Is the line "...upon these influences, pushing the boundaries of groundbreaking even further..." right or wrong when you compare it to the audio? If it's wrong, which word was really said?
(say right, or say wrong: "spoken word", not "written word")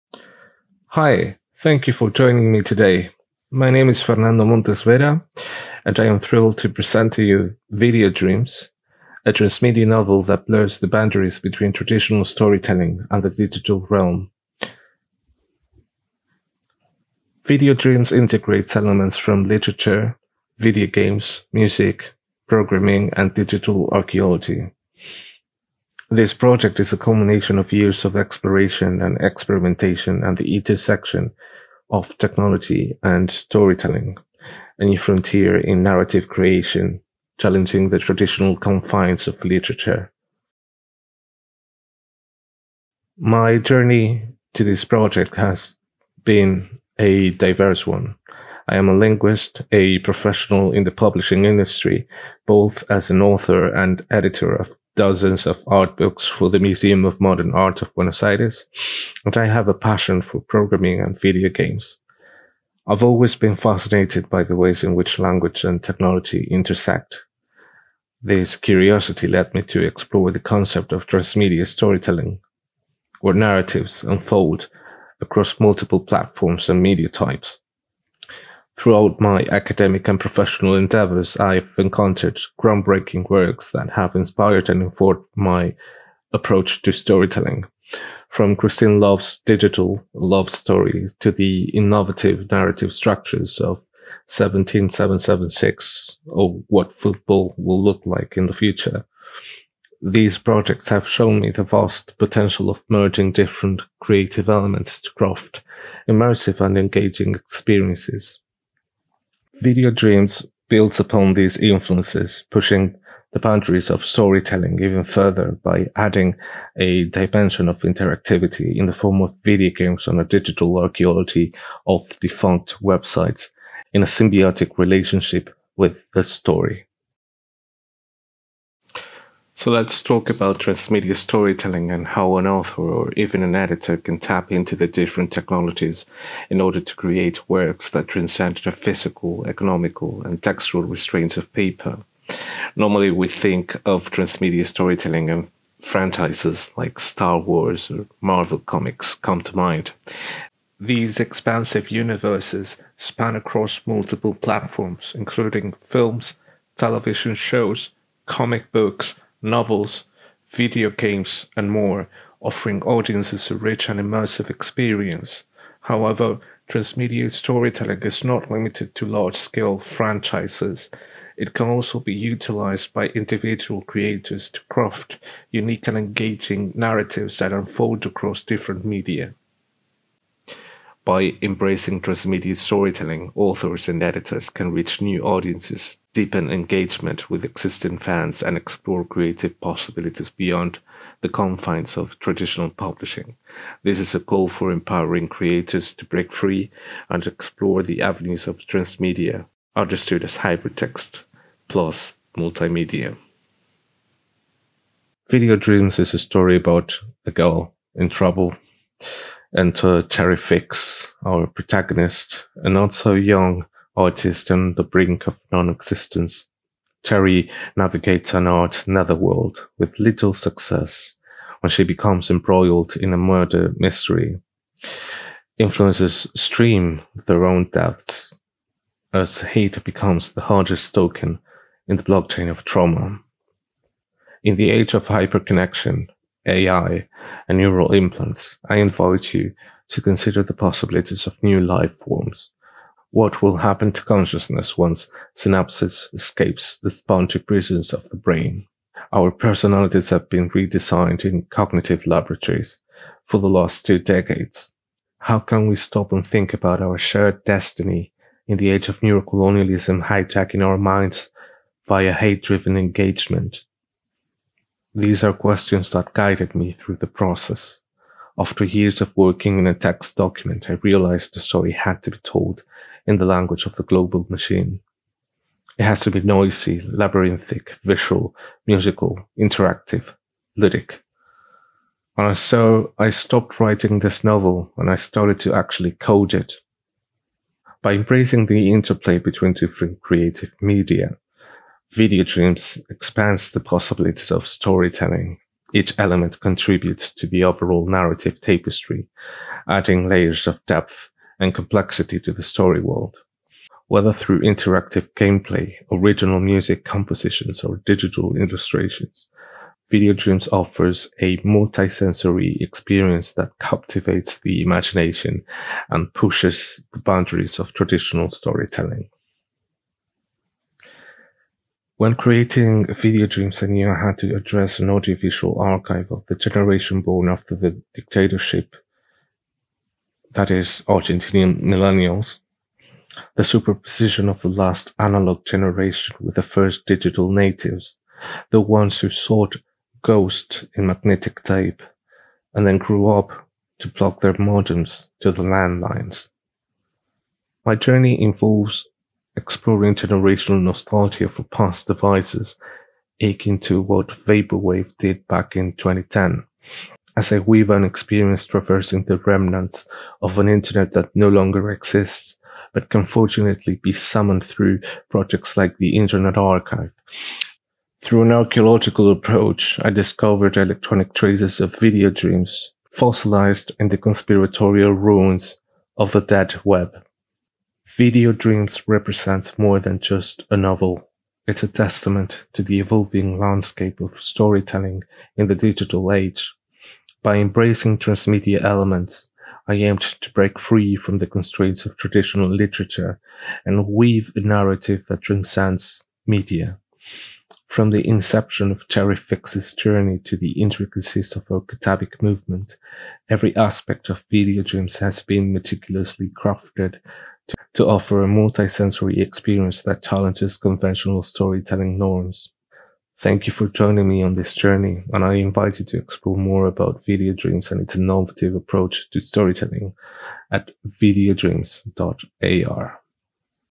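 wrong: "storytelling", not "groundbreaking".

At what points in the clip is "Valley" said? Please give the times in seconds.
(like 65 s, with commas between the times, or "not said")
not said.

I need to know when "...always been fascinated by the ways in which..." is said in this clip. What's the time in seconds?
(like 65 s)
63 s.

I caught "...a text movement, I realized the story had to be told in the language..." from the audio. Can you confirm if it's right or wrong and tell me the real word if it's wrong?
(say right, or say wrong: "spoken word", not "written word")
wrong: "document", not "movement".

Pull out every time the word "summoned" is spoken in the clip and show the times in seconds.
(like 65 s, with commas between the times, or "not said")
363 s.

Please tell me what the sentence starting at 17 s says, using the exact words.
Video Dreams integrates elements from literature, video games, music, programming, and digital archaeology.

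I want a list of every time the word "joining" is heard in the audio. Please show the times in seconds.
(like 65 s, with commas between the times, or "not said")
2 s, 413 s.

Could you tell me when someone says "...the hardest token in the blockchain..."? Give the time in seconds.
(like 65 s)
230 s.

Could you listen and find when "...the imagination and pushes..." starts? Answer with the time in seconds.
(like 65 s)
314 s.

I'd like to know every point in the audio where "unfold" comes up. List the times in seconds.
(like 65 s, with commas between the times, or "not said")
74 s, 177 s.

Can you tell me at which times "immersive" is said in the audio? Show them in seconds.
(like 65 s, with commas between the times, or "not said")
106 s, 163 s.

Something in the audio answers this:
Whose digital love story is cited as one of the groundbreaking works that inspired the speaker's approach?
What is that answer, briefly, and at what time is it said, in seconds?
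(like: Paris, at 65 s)
Christine Love, at 88 s.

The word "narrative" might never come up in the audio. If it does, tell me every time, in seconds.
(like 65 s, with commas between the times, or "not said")
35 s, 73 s, 92 s, 176 s, 297 s, 394 s.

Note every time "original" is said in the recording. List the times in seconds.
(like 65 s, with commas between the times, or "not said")
305 s.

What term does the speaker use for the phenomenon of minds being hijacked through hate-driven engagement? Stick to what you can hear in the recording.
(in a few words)
neurocolonialism.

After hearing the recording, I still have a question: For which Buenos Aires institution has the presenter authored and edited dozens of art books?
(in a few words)
Museum of Modern Art of Buenos Aires.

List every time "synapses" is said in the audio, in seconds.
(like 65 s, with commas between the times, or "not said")
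245 s.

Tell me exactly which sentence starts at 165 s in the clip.
However, transmedia storytelling is not limited to large scale franchises.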